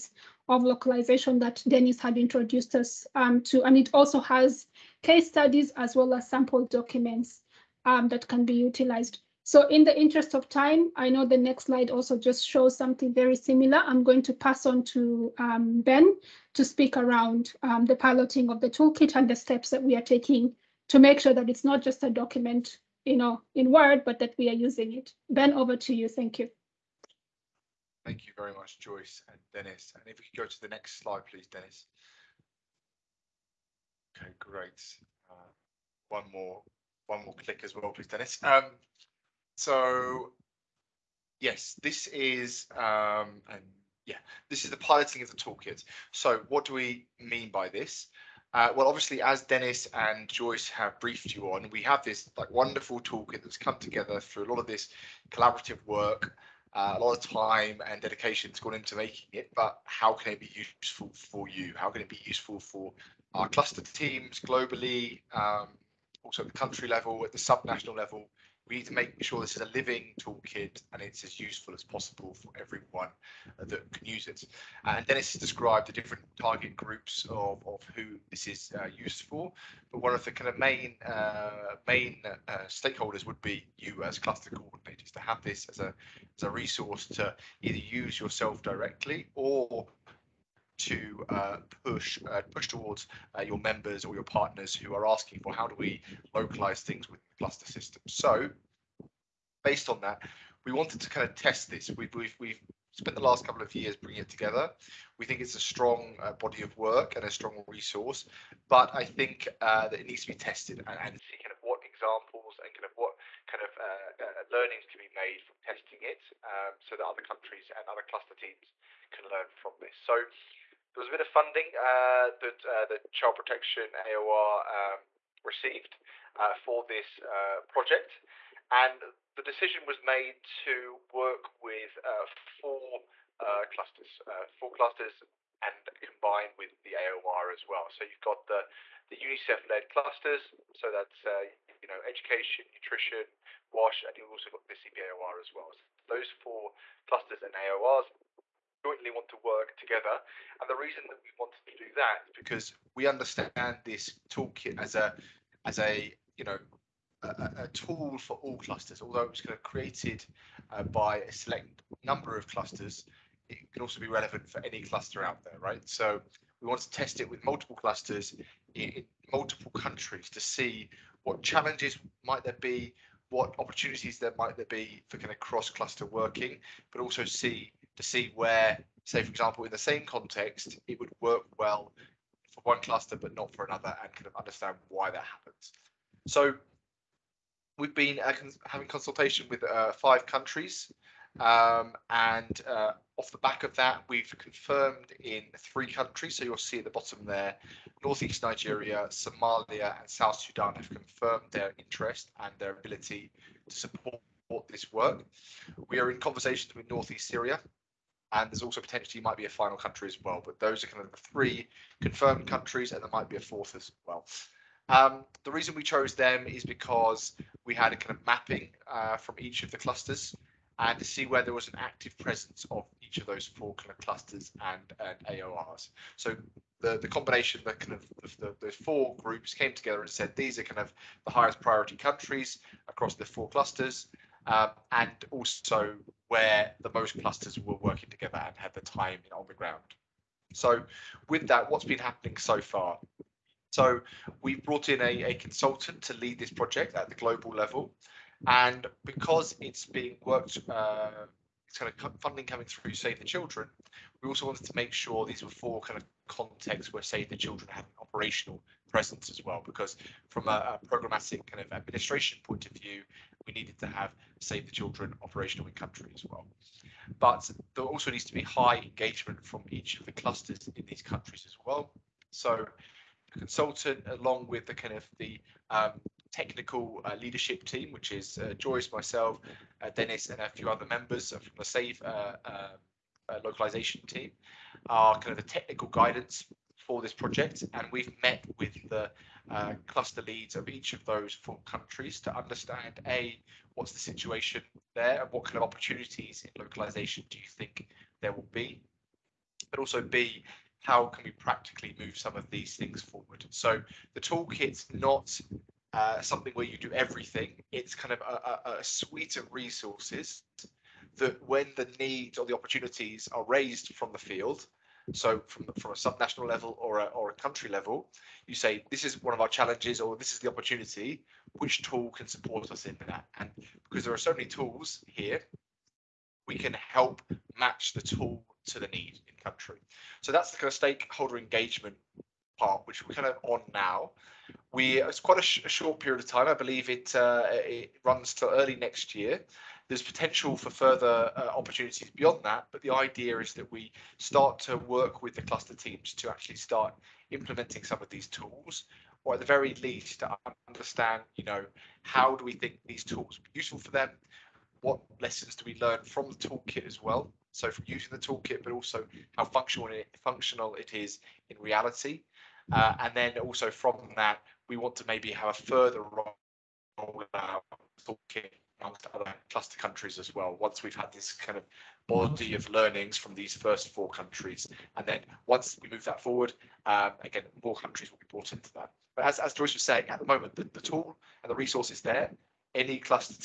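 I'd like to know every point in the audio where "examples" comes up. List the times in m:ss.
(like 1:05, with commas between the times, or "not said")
1:51, 2:59.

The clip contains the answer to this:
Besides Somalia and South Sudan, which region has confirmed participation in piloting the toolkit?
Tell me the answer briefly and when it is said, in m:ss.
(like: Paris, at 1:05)
northeast Nigeria, at 3:18.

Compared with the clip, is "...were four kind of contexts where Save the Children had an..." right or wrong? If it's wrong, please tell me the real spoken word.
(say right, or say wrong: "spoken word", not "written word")
right.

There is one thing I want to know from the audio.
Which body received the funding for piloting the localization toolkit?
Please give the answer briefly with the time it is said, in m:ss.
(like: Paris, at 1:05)
Child Protection AOR, at 2:03.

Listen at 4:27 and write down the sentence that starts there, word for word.
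But there also needs to be high engagement from each of the clusters in these countries as well.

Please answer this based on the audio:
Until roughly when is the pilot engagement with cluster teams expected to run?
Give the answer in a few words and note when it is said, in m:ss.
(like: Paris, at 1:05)
early next year, at 5:38.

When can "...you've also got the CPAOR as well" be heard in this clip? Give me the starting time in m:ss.
2:24.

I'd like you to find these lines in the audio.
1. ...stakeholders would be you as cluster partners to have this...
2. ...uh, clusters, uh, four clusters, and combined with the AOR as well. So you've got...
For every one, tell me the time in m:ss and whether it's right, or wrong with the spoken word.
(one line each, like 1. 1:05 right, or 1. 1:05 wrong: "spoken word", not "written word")
1. 1:22 wrong: "coordinators", not "partners"
2. 2:13 right.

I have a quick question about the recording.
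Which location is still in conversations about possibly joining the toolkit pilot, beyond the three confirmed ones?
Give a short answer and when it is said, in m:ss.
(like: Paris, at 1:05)
northeast Syria, at 3:26.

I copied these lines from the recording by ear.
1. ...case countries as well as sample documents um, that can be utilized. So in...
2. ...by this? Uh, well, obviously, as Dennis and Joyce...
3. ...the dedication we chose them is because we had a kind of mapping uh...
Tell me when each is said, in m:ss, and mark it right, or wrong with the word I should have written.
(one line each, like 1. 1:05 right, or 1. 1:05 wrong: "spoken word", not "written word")
1. 0:05 wrong: "studies", not "countries"
2. 0:47 right
3. 3:35 wrong: "reason", not "dedication".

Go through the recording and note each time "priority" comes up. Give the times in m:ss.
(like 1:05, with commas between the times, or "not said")
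3:51.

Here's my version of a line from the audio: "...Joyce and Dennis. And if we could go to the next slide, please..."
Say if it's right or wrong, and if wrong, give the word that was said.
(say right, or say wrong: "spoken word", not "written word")
right.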